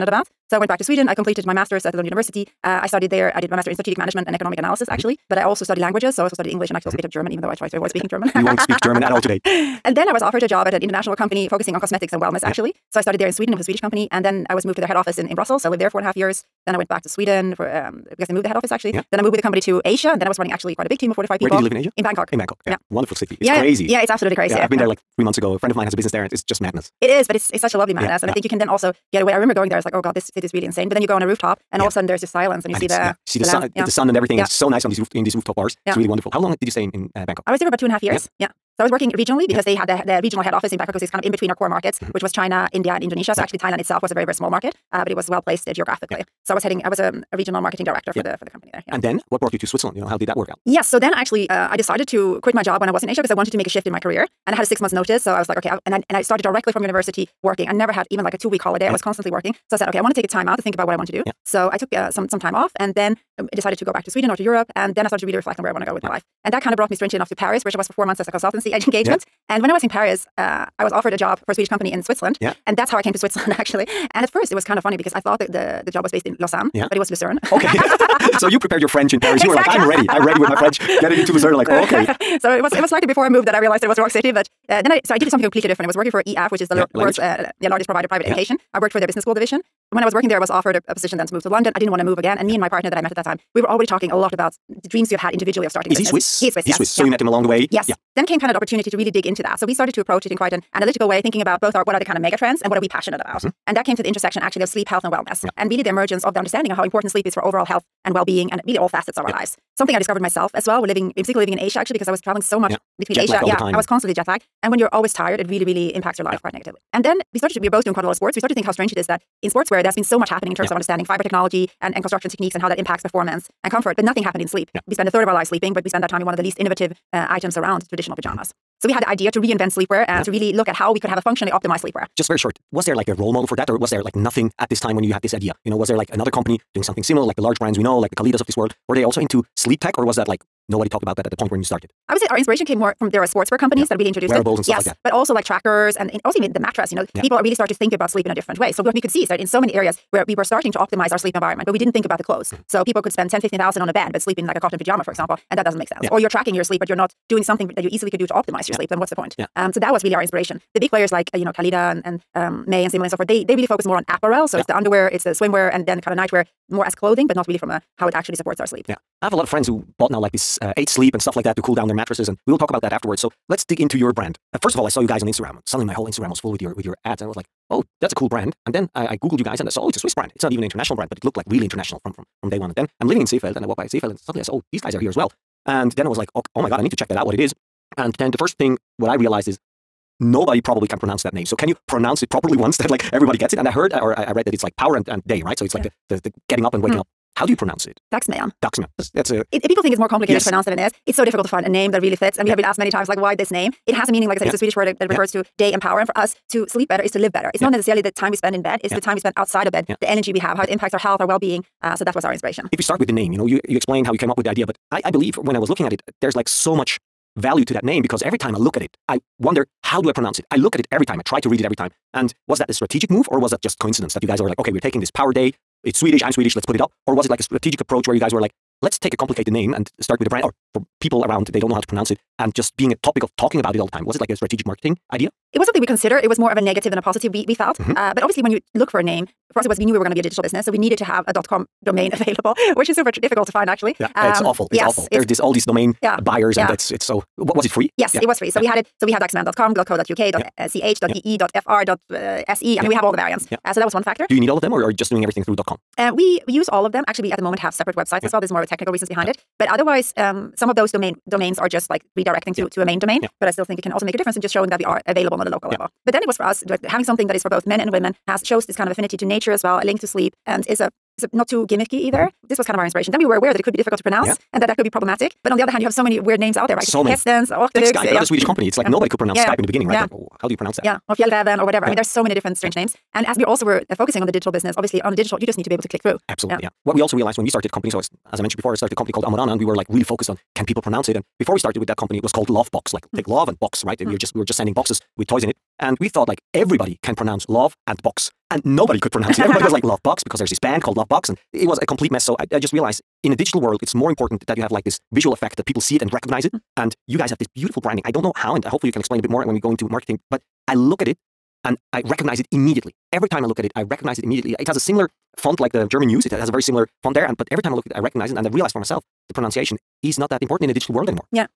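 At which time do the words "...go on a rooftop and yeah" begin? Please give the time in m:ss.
0:31.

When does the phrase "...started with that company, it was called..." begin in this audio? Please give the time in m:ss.
4:51.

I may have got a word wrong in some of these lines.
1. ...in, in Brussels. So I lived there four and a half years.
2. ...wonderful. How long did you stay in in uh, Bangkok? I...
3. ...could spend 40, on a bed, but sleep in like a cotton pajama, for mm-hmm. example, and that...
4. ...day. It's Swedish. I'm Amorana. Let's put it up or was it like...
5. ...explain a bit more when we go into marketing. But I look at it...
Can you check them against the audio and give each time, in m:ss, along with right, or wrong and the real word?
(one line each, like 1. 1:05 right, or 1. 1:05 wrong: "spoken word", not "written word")
1. 0:15 right
2. 0:36 right
3. 2:33 wrong: "10", not "40"
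4. 3:45 wrong: "Swedish", not "Amorana"
5. 5:09 right.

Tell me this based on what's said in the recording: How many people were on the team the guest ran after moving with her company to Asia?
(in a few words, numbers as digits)
45.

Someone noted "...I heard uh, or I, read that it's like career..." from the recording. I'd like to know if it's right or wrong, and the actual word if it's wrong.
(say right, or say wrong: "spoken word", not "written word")
wrong: "power", not "career".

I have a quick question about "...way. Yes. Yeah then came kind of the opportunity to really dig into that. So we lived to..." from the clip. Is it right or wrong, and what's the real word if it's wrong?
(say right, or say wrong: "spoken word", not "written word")
wrong: "started", not "lived".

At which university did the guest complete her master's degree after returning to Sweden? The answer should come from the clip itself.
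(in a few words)
Lund University.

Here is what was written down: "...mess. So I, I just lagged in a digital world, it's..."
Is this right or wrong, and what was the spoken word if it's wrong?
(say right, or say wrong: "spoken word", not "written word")
wrong: "realized", not "lagged".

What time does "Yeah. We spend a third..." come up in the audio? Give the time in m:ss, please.
2:04.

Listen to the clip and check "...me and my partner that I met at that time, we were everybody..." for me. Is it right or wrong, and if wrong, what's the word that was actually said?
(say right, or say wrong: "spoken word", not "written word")
wrong: "already", not "everybody".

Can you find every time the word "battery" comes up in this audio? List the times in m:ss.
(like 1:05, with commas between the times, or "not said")
not said.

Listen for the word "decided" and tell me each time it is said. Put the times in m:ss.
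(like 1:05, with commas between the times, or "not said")
0:51, 1:03.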